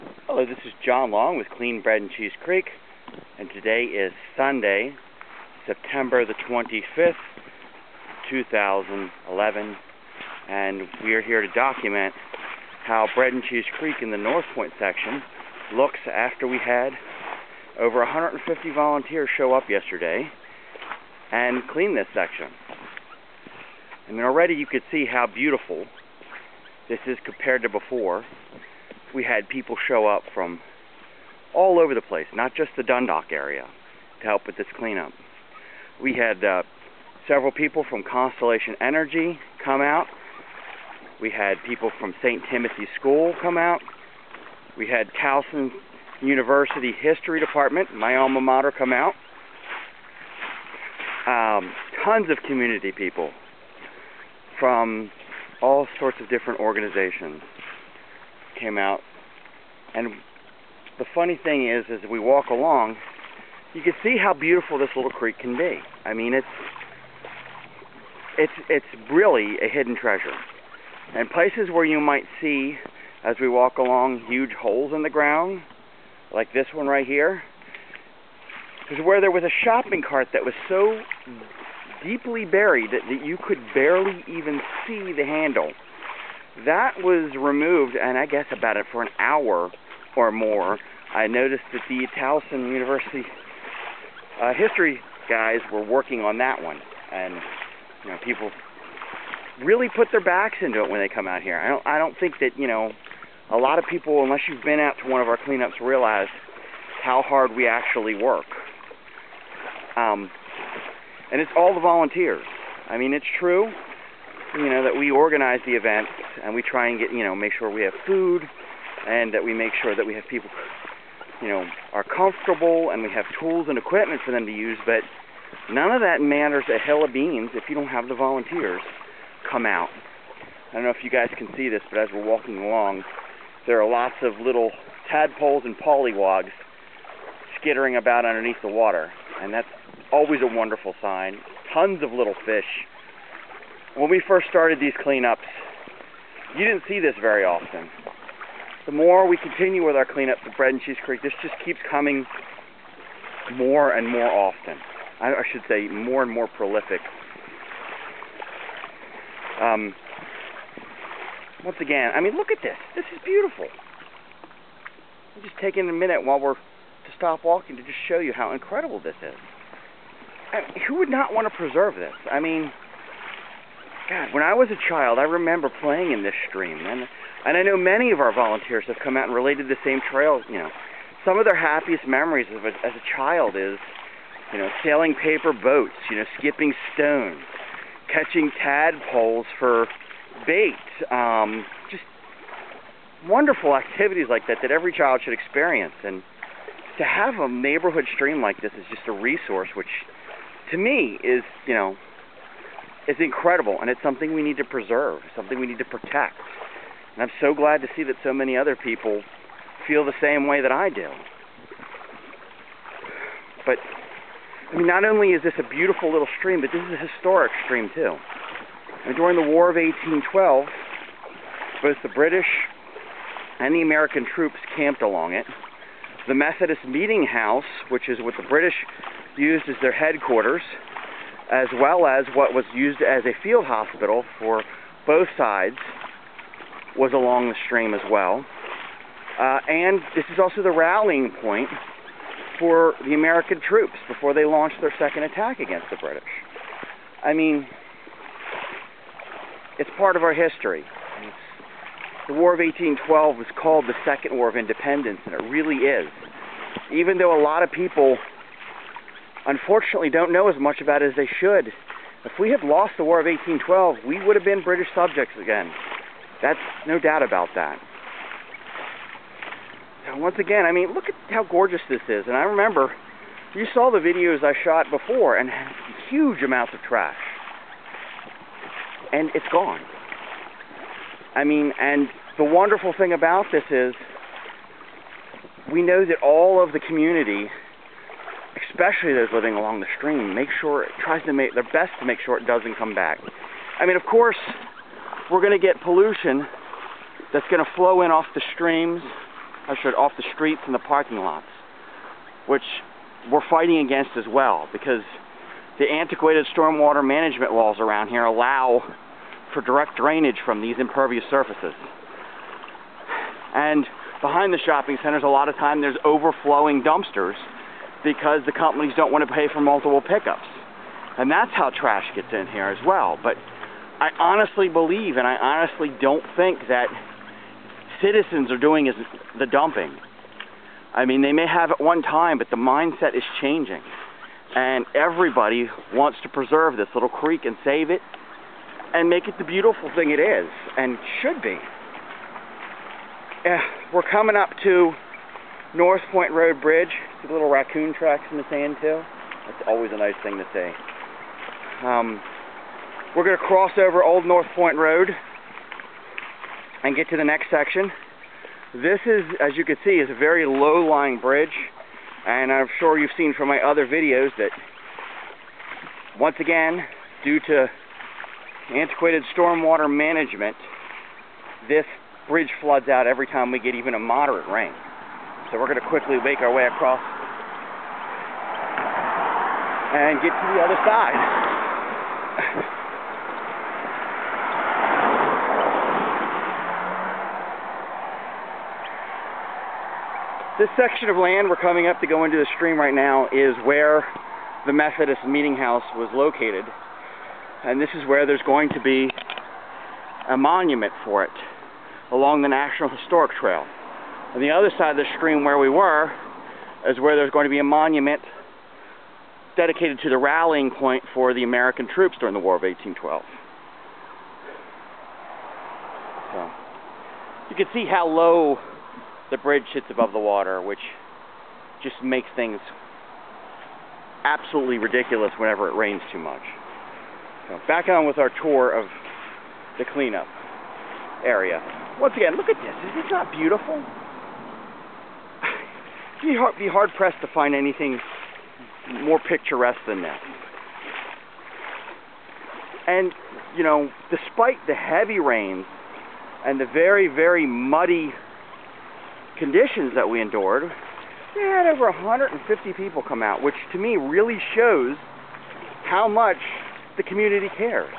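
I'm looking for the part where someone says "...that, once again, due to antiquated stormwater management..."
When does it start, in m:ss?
6:04.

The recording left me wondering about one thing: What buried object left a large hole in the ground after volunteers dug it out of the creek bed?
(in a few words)
Shopping cart.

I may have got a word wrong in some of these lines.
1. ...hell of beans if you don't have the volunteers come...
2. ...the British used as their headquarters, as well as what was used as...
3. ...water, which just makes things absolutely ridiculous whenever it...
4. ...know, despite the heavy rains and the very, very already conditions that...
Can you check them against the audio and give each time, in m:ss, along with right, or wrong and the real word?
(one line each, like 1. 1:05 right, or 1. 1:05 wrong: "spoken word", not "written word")
1. 2:06 right
2. 3:48 right
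3. 7:00 right
4. 7:23 wrong: "muddy", not "already".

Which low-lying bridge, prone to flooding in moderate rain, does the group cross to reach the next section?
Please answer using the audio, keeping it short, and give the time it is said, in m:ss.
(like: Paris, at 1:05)
North Point Road Bridge, at 5:45.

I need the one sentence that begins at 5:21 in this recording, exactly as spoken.
And that's how trash gets in here as well.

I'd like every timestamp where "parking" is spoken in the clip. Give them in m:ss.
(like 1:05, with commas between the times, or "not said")
5:00.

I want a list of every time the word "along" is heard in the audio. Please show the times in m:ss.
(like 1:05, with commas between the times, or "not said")
1:02, 1:13, 2:12, 3:45, 3:57, 4:49, 6:42.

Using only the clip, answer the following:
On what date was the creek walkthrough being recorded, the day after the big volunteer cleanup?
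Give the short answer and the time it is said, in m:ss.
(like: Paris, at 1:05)
September 25, 2011, at 0:05.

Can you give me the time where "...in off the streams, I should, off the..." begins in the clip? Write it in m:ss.
4:58.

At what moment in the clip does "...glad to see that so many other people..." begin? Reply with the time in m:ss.
3:27.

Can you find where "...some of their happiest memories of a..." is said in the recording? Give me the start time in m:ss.
3:01.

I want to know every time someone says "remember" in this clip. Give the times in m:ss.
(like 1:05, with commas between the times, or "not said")
2:55, 4:32.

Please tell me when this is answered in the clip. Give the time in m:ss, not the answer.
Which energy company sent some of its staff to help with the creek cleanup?
0:38.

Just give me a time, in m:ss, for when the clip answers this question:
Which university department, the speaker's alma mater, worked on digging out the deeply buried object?
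1:32.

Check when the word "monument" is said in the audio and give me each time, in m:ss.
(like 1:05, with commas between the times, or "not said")
6:40, 6:47.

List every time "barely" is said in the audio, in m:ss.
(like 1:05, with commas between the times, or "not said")
1:23.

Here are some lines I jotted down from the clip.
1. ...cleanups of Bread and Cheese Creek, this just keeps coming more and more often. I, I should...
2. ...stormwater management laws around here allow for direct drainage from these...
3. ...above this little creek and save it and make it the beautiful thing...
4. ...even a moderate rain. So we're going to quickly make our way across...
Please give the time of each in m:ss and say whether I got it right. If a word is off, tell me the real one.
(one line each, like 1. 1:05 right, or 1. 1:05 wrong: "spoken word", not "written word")
1. 2:30 right
2. 5:06 right
3. 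5:36 wrong: "preserve", not "above"
4. 6:13 right.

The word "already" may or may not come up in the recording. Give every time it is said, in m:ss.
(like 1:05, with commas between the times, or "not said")
0:24.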